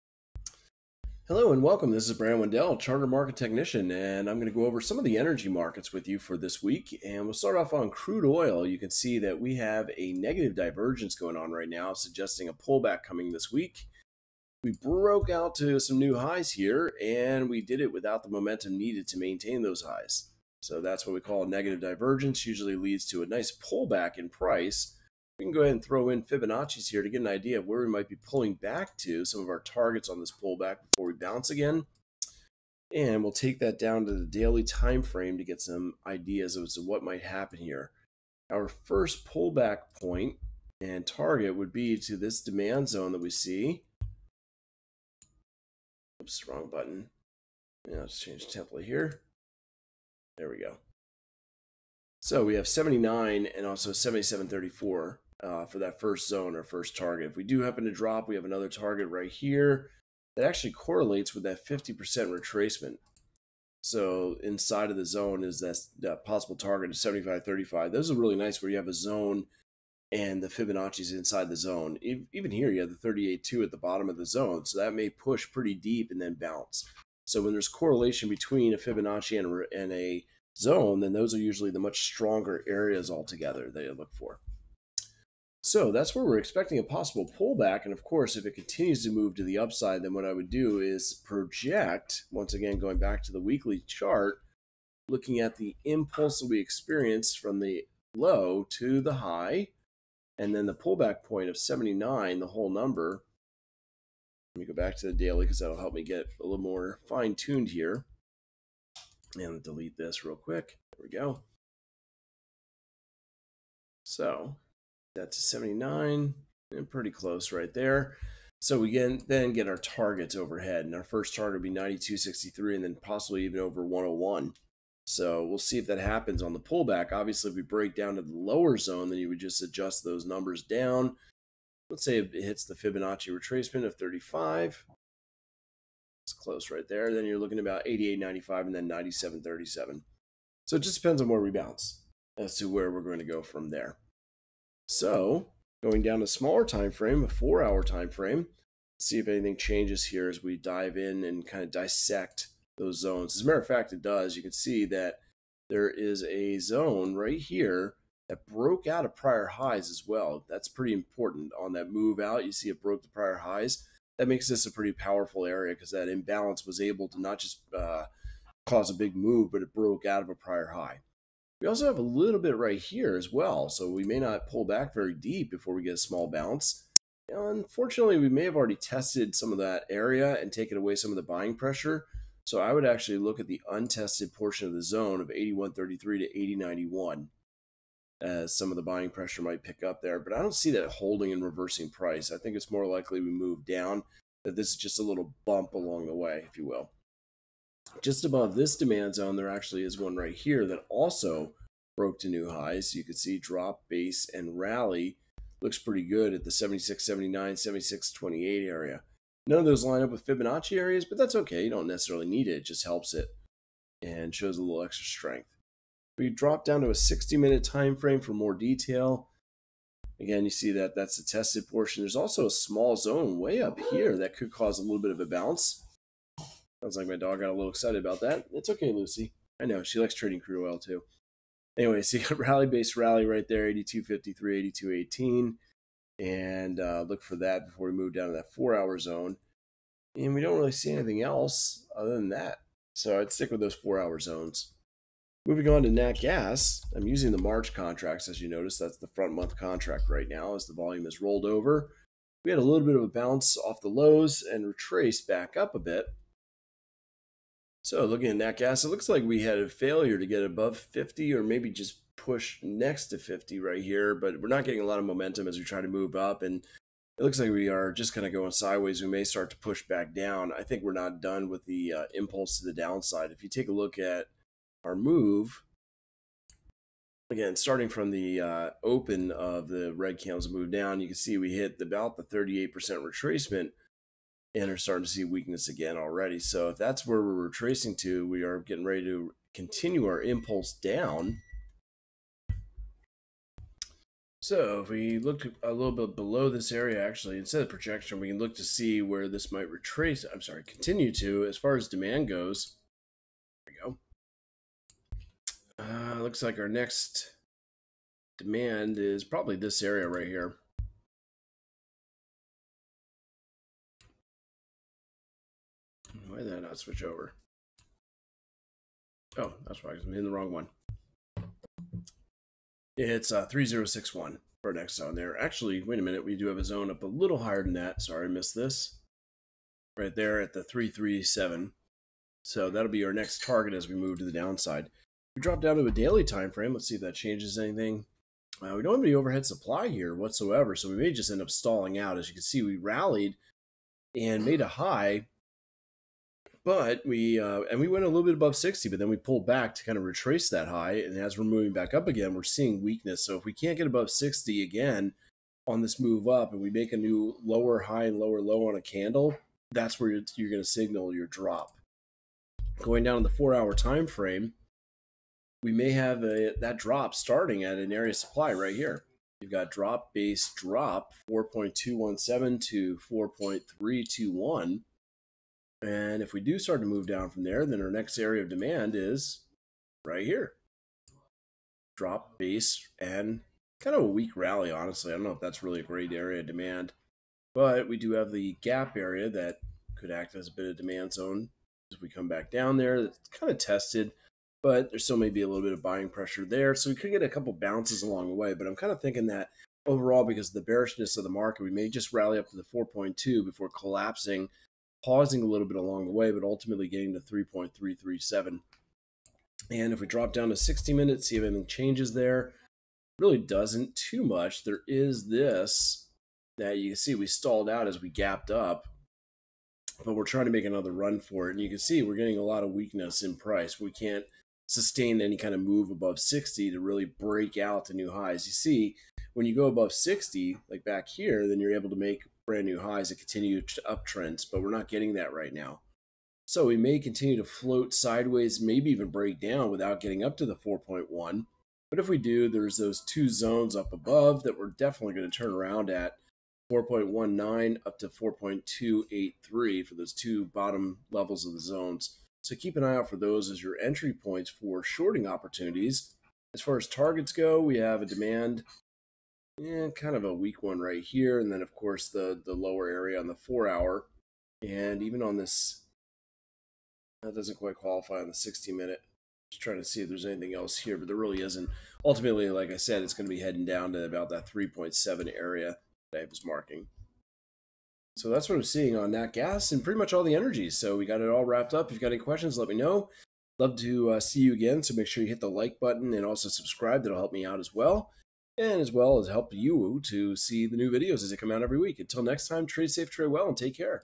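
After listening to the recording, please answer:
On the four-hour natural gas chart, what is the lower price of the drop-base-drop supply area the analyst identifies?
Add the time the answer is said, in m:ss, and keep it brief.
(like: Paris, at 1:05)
4.217, at 6:11.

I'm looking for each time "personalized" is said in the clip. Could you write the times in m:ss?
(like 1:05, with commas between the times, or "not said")
not said.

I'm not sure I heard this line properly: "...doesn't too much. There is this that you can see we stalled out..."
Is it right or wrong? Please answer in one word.
right.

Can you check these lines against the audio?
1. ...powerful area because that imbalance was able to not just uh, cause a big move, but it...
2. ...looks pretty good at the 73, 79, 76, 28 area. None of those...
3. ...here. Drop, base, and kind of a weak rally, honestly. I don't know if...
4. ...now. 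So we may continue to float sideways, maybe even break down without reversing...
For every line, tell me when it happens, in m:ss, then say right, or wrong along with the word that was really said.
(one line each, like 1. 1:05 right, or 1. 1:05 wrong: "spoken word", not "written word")
1. 2:44 right
2. 3:25 wrong: "76", not "73"
3. 6:20 right
4. 7:15 wrong: "getting", not "reversing".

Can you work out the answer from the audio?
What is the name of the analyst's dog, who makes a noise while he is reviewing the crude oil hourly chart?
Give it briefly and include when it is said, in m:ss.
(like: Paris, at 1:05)
Lucy, at 3:48.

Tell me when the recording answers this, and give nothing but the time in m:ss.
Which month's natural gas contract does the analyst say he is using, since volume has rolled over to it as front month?
4:07.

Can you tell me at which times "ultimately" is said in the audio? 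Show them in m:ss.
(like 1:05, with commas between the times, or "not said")
6:46, 7:52.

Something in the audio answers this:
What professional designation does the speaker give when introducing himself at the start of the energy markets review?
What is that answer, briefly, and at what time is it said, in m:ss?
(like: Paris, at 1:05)
Charter Market Technician, at 0:02.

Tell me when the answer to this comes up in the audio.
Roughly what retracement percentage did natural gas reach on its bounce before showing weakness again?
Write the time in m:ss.
4:42.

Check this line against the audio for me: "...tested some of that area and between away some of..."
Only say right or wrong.
wrong.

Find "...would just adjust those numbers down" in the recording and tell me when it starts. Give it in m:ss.
2:09.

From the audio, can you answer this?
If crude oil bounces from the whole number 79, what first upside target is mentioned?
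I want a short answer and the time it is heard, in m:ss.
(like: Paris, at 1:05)
92.63, at 2:01.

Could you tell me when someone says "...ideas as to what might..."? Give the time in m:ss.
0:36.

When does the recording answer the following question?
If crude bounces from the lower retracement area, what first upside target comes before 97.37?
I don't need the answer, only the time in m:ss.
2:17.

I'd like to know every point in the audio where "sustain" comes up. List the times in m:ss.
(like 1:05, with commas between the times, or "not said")
7:04.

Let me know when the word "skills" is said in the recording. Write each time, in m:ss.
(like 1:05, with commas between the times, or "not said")
not said.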